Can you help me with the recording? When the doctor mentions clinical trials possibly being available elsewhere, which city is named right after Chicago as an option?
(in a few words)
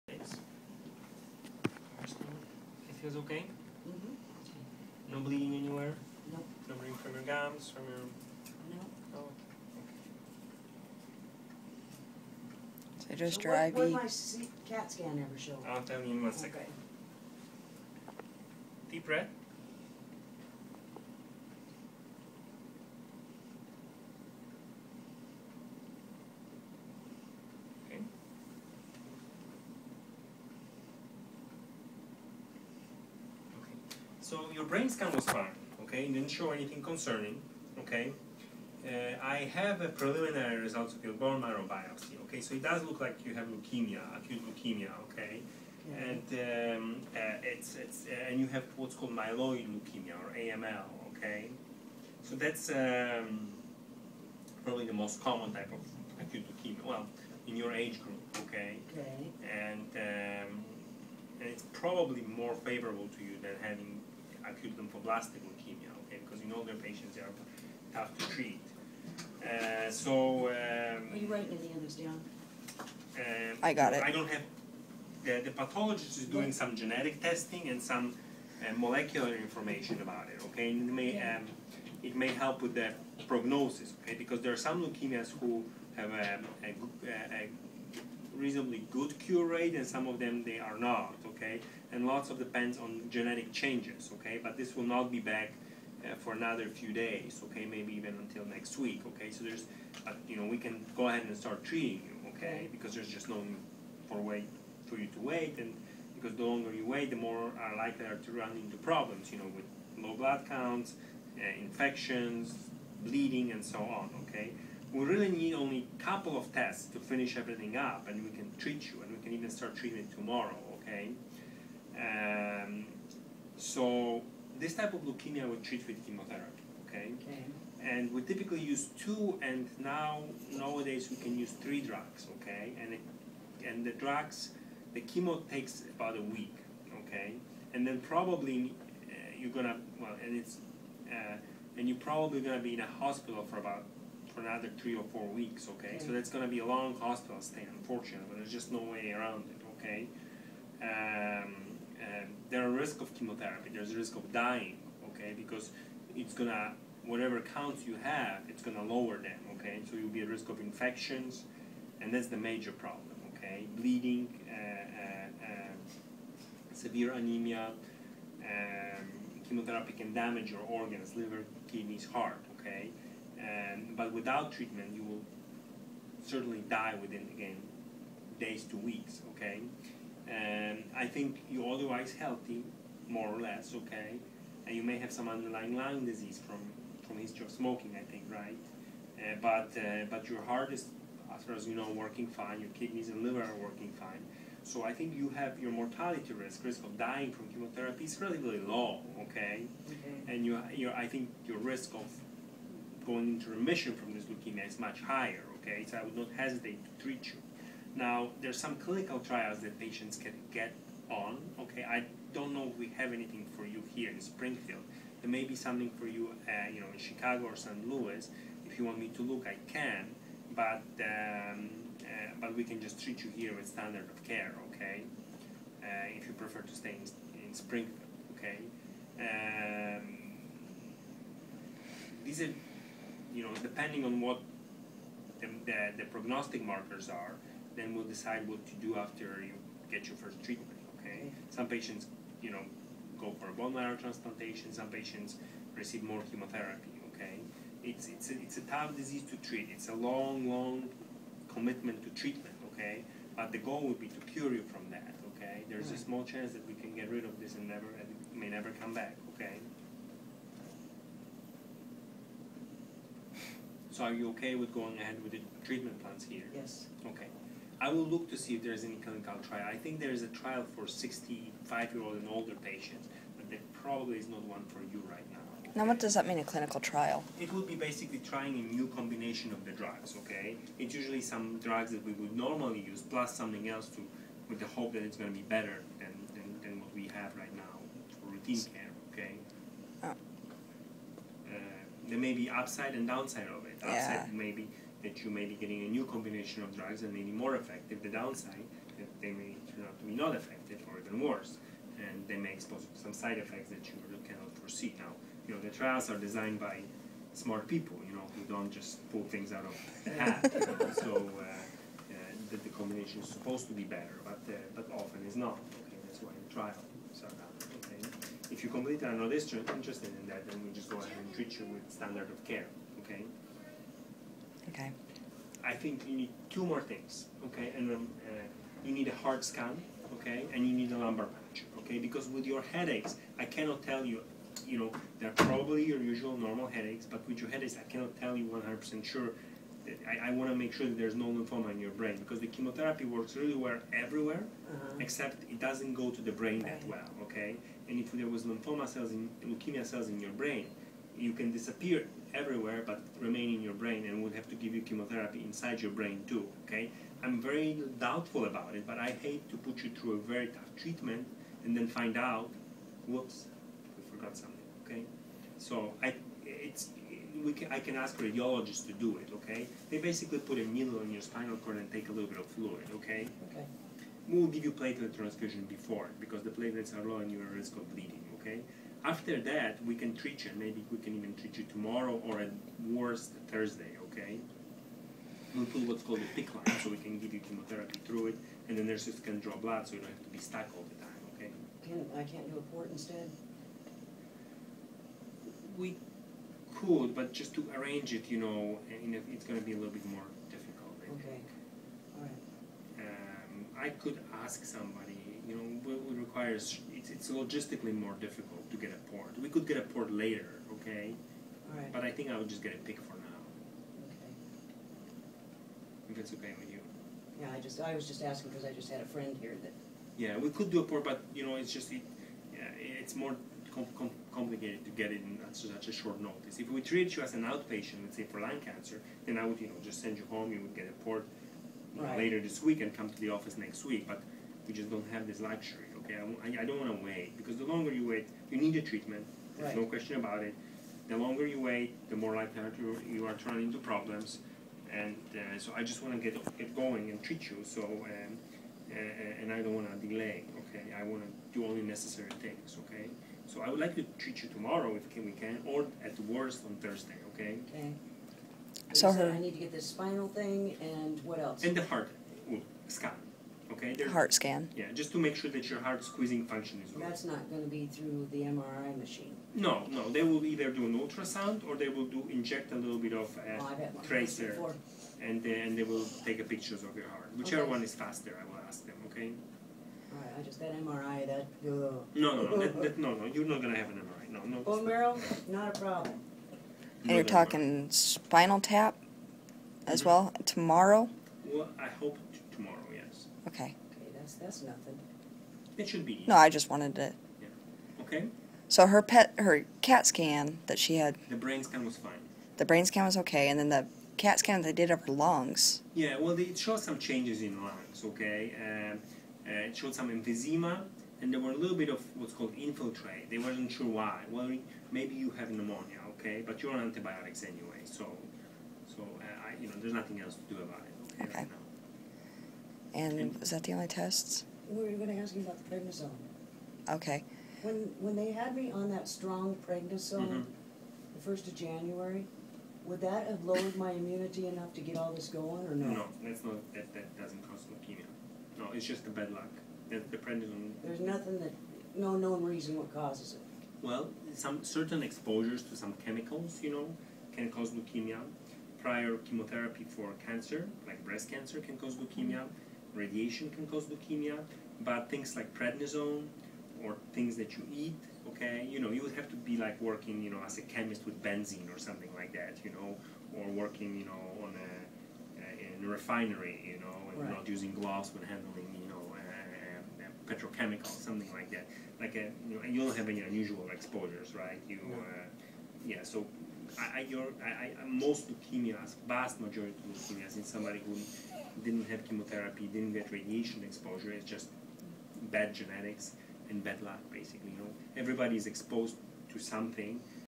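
St. Louis.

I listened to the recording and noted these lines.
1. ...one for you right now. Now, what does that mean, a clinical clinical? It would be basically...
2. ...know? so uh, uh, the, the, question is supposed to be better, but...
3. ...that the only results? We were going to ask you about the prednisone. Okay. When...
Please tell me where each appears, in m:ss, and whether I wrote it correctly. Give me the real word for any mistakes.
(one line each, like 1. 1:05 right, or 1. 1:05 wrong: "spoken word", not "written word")
1. 4:34 wrong: "trial", not "clinical"
2. 5:10 wrong: "combination", not "question"
3. 8:43 wrong: "tests", not "results".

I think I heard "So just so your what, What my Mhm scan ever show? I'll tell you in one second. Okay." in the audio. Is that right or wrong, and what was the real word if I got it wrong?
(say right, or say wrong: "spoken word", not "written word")
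wrong: "CAT", not "Mhm".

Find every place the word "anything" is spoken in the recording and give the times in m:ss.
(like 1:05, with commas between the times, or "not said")
0:36, 3:33.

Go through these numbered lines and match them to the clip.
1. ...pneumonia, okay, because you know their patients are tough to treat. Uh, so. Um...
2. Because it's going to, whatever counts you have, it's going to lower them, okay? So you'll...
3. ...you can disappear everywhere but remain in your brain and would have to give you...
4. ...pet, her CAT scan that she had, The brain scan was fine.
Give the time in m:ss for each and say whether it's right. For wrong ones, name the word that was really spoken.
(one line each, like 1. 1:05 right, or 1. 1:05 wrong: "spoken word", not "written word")
1. 1:05 wrong: "leukemia", not "pneumonia"
2. 2:35 right
3. 5:51 right
4. 8:19 right.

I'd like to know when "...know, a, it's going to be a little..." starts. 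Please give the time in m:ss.
6:38.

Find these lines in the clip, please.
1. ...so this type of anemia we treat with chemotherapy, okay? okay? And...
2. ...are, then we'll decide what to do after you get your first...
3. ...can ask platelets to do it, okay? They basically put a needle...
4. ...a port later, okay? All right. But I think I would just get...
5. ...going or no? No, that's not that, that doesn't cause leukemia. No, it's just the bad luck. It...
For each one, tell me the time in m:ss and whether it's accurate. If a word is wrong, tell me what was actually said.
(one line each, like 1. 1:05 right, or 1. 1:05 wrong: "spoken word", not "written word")
1. 2:03 wrong: "leukemia", not "anemia"
2. 3:57 right
3. 6:07 wrong: "radiologists", not "platelets"
4. 6:49 right
5. 8:55 right.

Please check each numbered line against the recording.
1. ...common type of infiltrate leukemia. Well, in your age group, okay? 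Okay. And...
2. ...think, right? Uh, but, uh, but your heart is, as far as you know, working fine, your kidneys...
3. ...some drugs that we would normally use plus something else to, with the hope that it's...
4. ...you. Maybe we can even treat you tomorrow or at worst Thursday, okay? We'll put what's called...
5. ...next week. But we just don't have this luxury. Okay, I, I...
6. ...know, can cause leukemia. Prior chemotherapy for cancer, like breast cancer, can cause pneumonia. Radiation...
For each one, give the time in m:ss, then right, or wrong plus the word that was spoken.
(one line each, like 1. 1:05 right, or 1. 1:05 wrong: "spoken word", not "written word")
1. 0:55 wrong: "acute", not "infiltrate"
2. 3:08 right
3. 4:41 right
4. 6:20 right
5. 7:13 right
6. 9:06 wrong: "leukemia", not "pneumonia".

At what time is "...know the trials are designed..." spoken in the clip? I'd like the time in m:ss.
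5:05.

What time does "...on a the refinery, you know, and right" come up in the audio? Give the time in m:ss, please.
9:24.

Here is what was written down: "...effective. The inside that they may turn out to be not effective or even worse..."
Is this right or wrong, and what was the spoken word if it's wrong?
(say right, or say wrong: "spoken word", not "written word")
wrong: "downside", not "inside".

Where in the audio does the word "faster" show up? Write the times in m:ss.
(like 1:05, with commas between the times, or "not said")
7:57.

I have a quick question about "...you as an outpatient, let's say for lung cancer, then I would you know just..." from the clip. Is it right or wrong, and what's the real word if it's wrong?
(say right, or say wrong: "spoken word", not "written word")
right.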